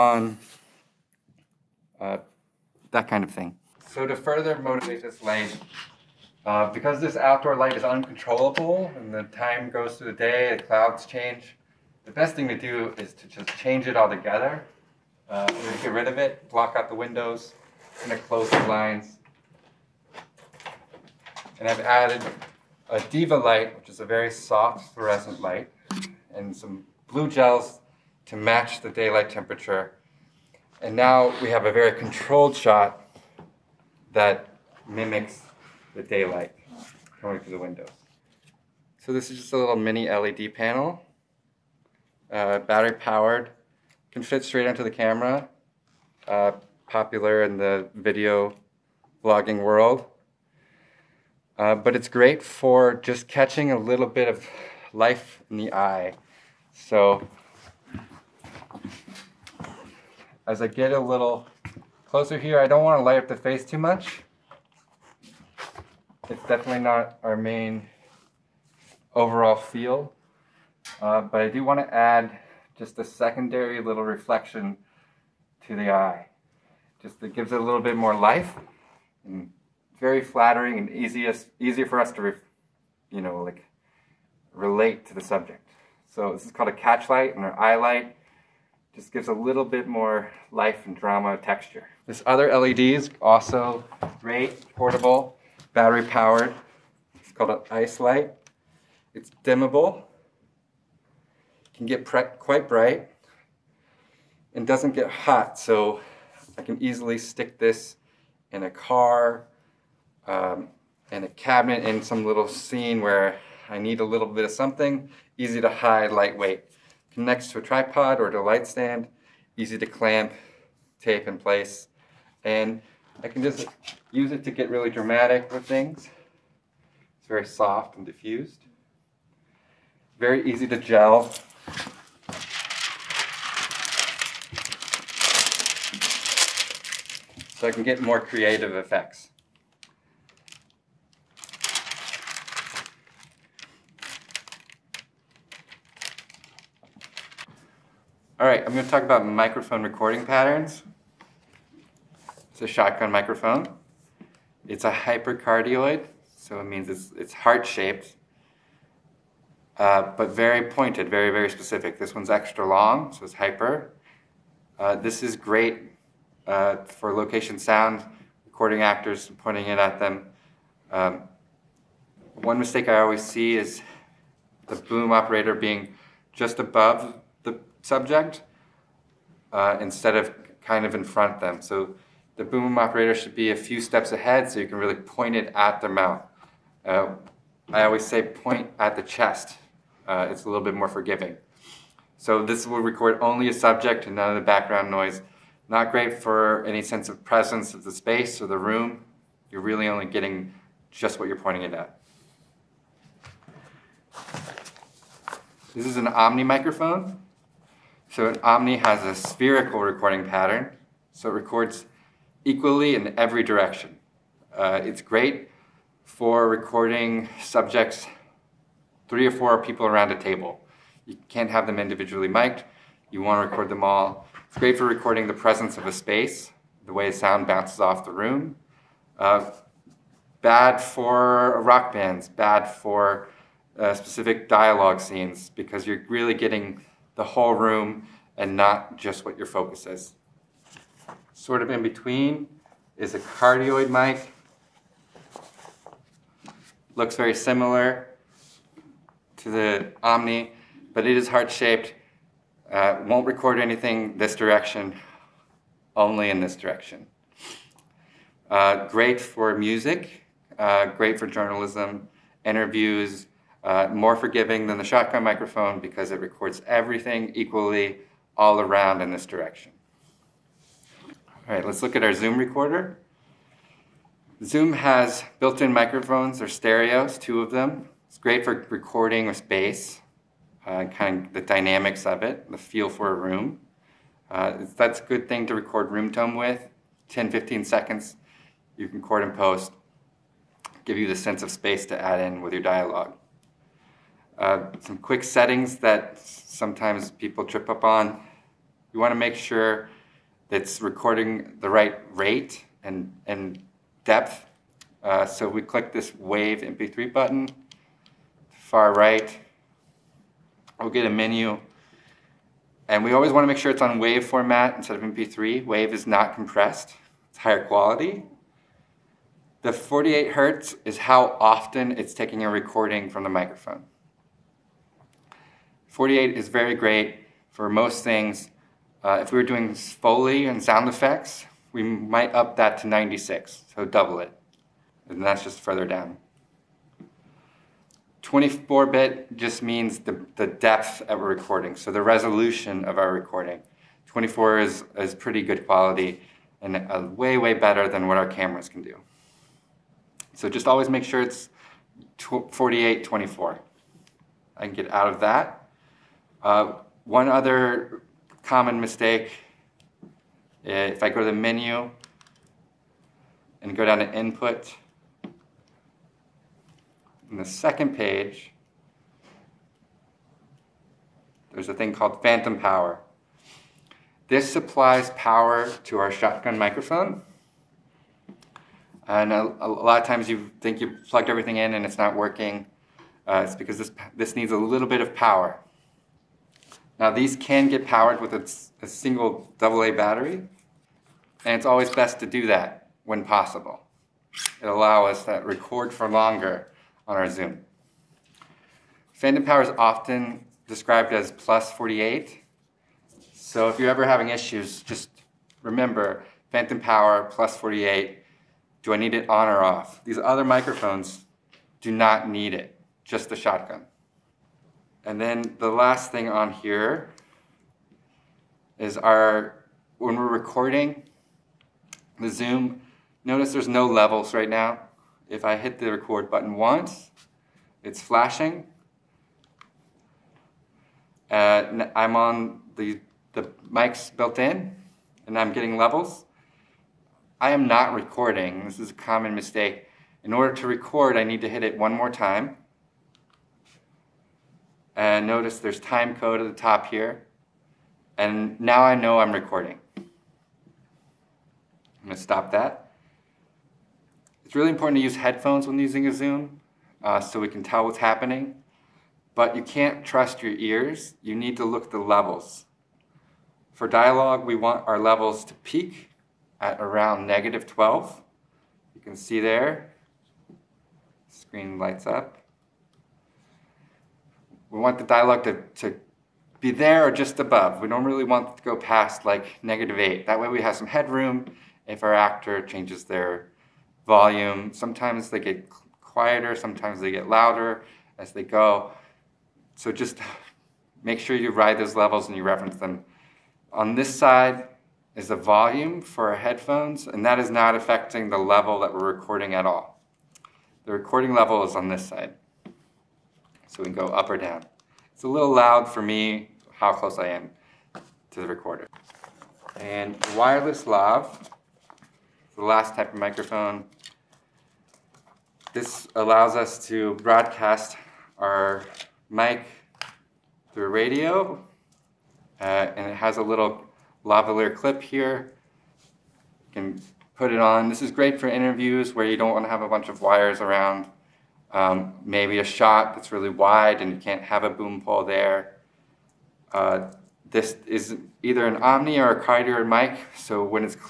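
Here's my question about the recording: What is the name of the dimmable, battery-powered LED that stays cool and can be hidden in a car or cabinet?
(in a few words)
Ice light.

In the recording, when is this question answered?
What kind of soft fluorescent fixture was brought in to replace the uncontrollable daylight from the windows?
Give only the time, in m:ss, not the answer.
0:23.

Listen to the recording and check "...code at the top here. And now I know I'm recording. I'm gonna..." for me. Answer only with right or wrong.
right.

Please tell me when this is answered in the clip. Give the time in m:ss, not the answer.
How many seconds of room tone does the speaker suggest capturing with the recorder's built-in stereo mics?
4:47.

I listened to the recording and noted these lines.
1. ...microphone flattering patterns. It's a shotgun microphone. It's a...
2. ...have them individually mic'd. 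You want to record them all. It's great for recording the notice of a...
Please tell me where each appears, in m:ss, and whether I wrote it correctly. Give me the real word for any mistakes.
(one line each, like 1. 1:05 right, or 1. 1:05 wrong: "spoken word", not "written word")
1. 2:29 wrong: "recording", not "flattering"
2. 3:41 wrong: "presence", not "notice".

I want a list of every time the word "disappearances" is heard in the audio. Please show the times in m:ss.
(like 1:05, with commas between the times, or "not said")
not said.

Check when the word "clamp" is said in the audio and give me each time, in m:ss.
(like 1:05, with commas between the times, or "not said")
1:59.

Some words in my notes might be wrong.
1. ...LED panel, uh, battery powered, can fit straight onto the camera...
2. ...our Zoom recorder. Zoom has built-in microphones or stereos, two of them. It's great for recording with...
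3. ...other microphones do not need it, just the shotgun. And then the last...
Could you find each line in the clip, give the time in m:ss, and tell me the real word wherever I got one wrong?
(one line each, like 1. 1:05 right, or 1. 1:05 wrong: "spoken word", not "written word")
1. 0:40 right
2. 4:32 right
3. 6:50 right.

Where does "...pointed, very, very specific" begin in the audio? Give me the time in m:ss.
2:40.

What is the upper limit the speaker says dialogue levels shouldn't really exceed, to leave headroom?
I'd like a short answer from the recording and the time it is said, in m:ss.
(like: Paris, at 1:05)
-8, at 7:59.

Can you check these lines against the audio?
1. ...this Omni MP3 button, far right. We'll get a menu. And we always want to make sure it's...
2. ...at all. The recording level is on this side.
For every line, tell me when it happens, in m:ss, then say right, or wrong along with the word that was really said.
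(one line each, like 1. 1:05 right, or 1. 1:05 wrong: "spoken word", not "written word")
1. 5:05 wrong: "Wave", not "Omni"
2. 8:19 right.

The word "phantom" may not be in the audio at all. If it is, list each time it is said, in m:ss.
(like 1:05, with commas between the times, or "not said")
6:12, 6:39, 6:46.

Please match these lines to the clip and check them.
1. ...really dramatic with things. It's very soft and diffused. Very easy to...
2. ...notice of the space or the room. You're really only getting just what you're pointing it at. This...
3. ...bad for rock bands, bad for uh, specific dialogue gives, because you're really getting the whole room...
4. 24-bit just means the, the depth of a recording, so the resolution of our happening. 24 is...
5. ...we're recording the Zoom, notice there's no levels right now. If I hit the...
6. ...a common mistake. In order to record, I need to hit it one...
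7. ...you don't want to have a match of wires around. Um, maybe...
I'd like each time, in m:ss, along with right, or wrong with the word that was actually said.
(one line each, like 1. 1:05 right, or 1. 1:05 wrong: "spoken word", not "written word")
1. 2:04 right
2. 3:17 wrong: "presence", not "notice"
3. 3:50 wrong: "scenes", not "gives"
4. 5:38 wrong: "recording", not "happening"
5. 7:00 right
6. 7:18 right
7. 8:49 wrong: "bunch", not "match".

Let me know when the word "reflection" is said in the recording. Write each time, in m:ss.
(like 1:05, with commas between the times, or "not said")
1:14.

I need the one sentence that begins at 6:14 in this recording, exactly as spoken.
This supplies power to our shotgun microphone.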